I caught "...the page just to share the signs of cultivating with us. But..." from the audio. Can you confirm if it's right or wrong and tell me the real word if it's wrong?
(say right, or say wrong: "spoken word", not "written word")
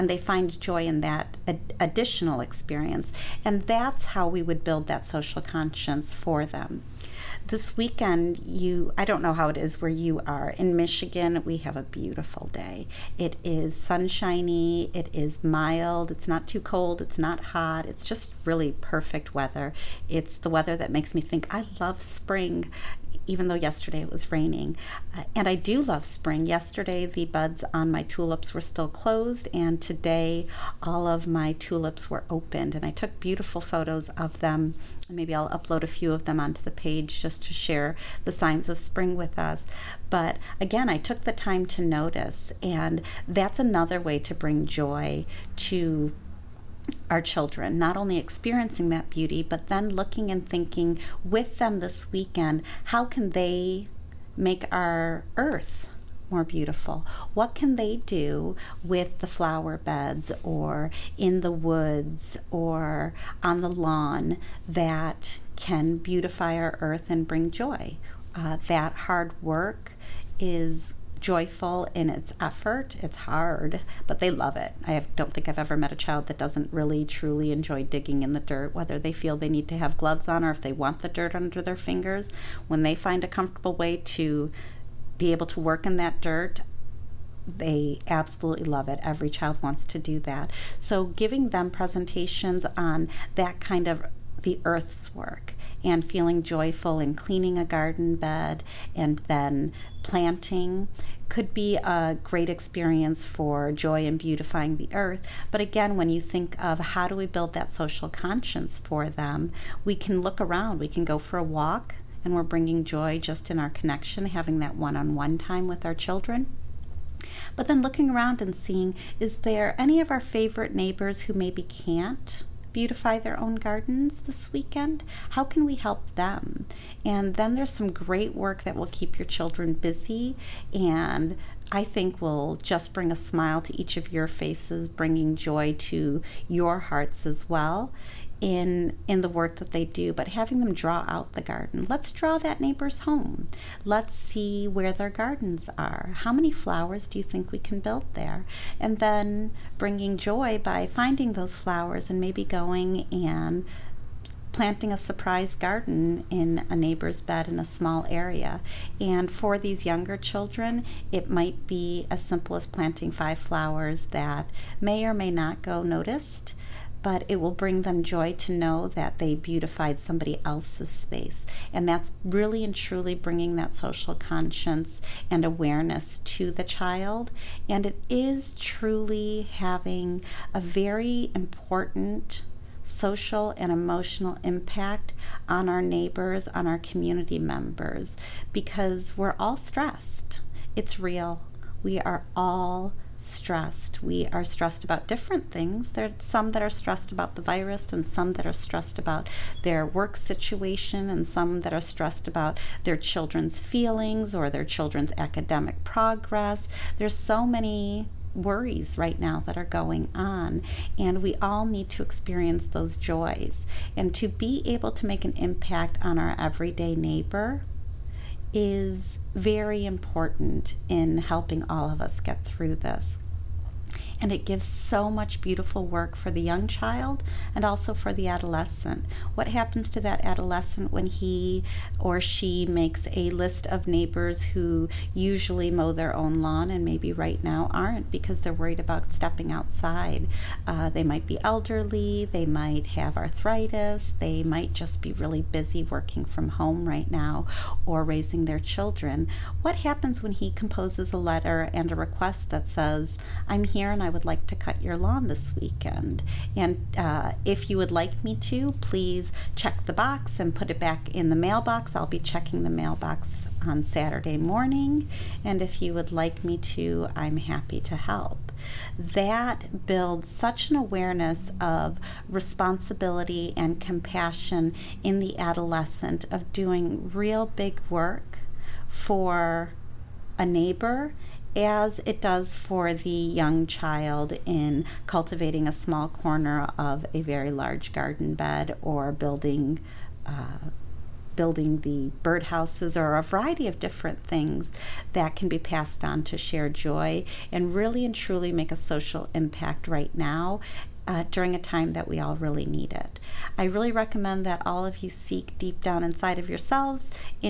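wrong: "spring", not "cultivating".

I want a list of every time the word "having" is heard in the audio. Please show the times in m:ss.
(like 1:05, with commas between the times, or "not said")
1:54, 2:20, 2:59.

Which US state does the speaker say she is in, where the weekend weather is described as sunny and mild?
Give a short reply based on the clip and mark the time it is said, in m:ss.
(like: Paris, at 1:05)
Michigan, at 0:10.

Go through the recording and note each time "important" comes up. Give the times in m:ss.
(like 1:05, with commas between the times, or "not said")
3:01, 3:39.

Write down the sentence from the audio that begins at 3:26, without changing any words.
There's so many worries right now that are going on.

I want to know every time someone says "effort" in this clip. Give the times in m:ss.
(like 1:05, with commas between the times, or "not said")
1:12.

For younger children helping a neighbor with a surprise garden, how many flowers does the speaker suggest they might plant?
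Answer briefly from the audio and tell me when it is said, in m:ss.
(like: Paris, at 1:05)
5, at 2:43.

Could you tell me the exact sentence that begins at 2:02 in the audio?
beautify their own gardens this weekend?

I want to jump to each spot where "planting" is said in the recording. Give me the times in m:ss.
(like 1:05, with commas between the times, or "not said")
1:40, 2:34, 2:42.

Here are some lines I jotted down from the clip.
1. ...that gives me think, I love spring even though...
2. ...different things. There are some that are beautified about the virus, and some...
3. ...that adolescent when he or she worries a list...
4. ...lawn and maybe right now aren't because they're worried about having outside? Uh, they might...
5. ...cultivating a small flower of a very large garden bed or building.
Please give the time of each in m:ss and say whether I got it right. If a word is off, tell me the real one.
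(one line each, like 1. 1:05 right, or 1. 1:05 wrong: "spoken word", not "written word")
1. 0:20 wrong: "makes", not "gives"
2. 3:15 wrong: "stressed", not "beautified"
3. 3:50 wrong: "makes", not "worries"
4. 3:56 wrong: "stepping", not "having"
5. 4:45 wrong: "corner", not "flower".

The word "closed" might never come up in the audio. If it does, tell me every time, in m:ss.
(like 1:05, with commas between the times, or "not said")
0:28.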